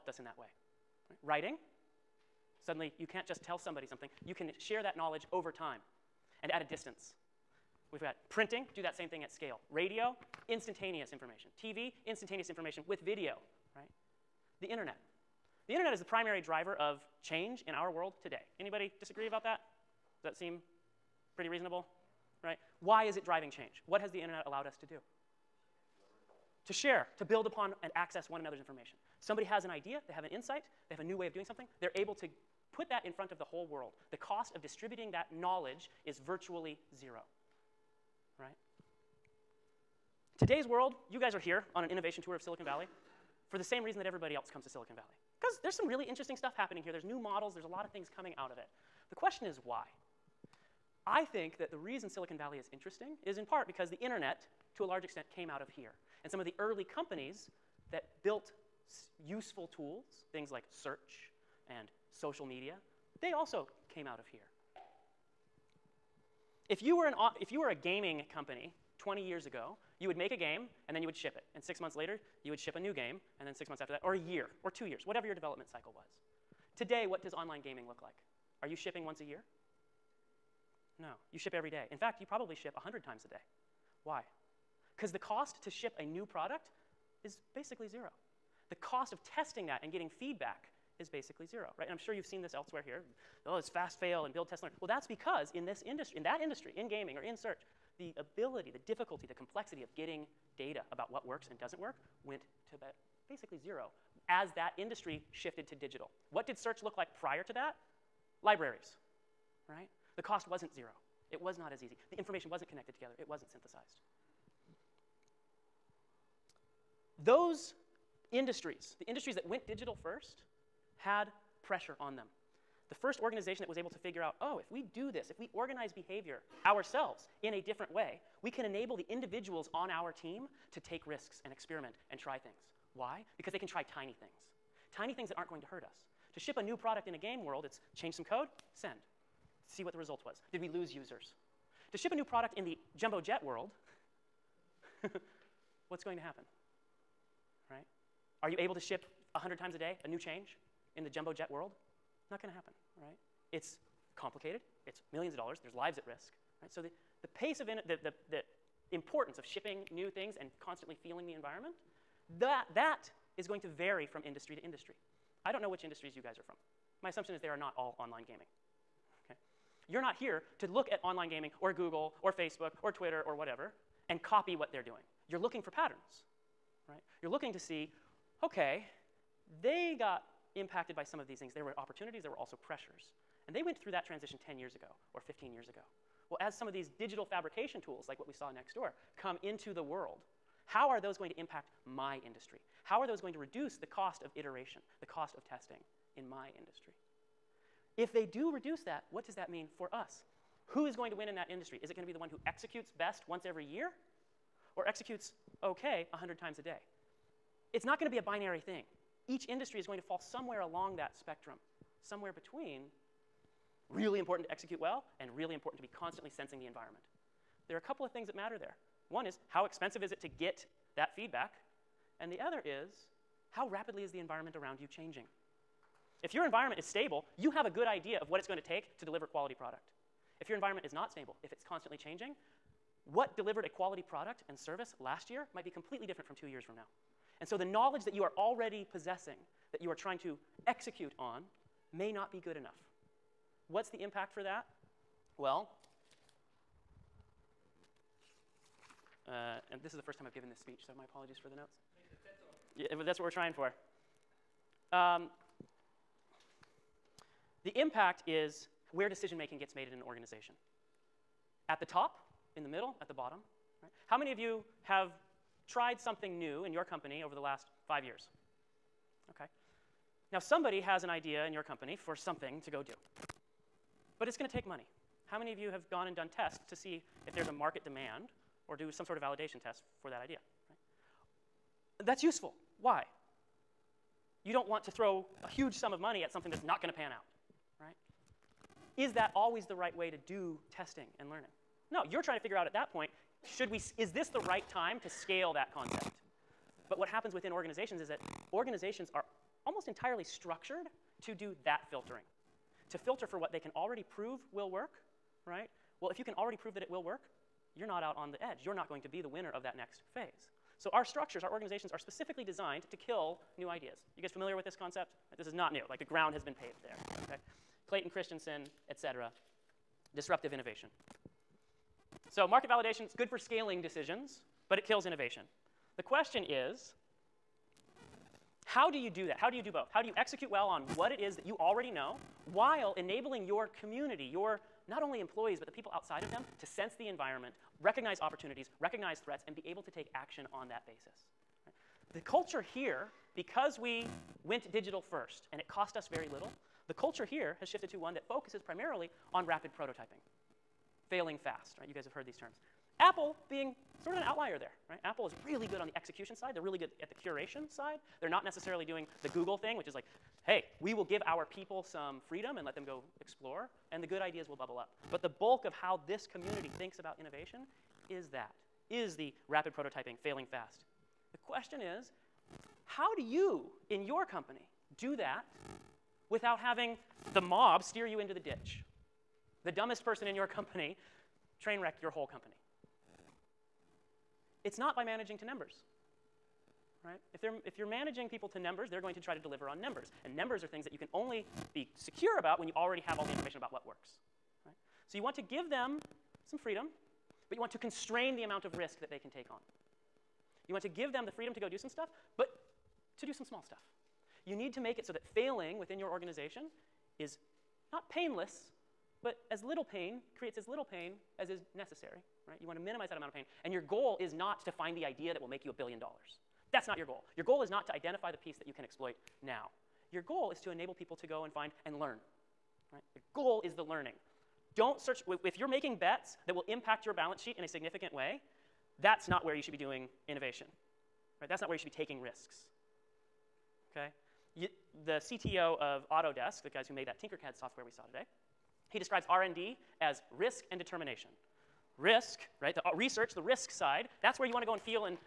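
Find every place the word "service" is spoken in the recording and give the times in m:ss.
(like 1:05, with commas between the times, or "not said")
3:54.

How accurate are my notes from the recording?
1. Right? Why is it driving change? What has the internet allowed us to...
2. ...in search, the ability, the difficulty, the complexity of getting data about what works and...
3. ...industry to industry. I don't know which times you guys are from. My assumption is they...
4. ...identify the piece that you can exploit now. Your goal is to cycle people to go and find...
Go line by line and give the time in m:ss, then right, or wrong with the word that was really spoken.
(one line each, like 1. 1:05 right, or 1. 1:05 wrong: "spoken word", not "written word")
1. 0:22 right
2. 1:37 right
3. 2:44 wrong: "industries", not "times"
4. 6:57 wrong: "enable", not "cycle".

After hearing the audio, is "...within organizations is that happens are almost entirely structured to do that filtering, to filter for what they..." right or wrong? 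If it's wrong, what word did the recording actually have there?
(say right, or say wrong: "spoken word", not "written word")
wrong: "organizations", not "happens".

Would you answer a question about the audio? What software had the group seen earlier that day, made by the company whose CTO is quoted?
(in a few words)
Tinkercad.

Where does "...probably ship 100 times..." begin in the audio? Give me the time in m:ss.
1:22.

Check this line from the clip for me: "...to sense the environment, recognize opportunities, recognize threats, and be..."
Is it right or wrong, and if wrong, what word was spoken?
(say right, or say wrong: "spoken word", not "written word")
right.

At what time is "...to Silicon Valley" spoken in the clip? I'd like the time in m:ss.
0:44.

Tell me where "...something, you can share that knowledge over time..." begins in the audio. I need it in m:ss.
0:03.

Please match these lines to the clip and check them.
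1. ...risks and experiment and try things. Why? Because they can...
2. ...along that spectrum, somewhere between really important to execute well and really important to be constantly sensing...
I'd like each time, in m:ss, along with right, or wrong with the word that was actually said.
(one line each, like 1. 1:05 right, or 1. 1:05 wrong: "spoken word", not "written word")
1. 2:11 right
2. 3:30 right.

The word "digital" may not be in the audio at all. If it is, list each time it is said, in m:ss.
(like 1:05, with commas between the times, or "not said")
1:45, 1:59, 3:06, 5:44.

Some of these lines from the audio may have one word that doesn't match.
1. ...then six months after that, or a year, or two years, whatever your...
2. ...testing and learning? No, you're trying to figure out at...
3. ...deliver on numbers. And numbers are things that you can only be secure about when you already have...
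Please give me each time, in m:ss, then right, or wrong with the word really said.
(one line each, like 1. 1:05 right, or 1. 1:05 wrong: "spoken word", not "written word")
1. 1:13 right
2. 4:50 right
3. 6:29 right.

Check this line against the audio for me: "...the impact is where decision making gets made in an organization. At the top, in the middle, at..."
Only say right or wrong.
right.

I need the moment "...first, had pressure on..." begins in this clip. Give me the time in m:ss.
2:00.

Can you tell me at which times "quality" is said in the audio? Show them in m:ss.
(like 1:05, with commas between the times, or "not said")
3:49, 3:53.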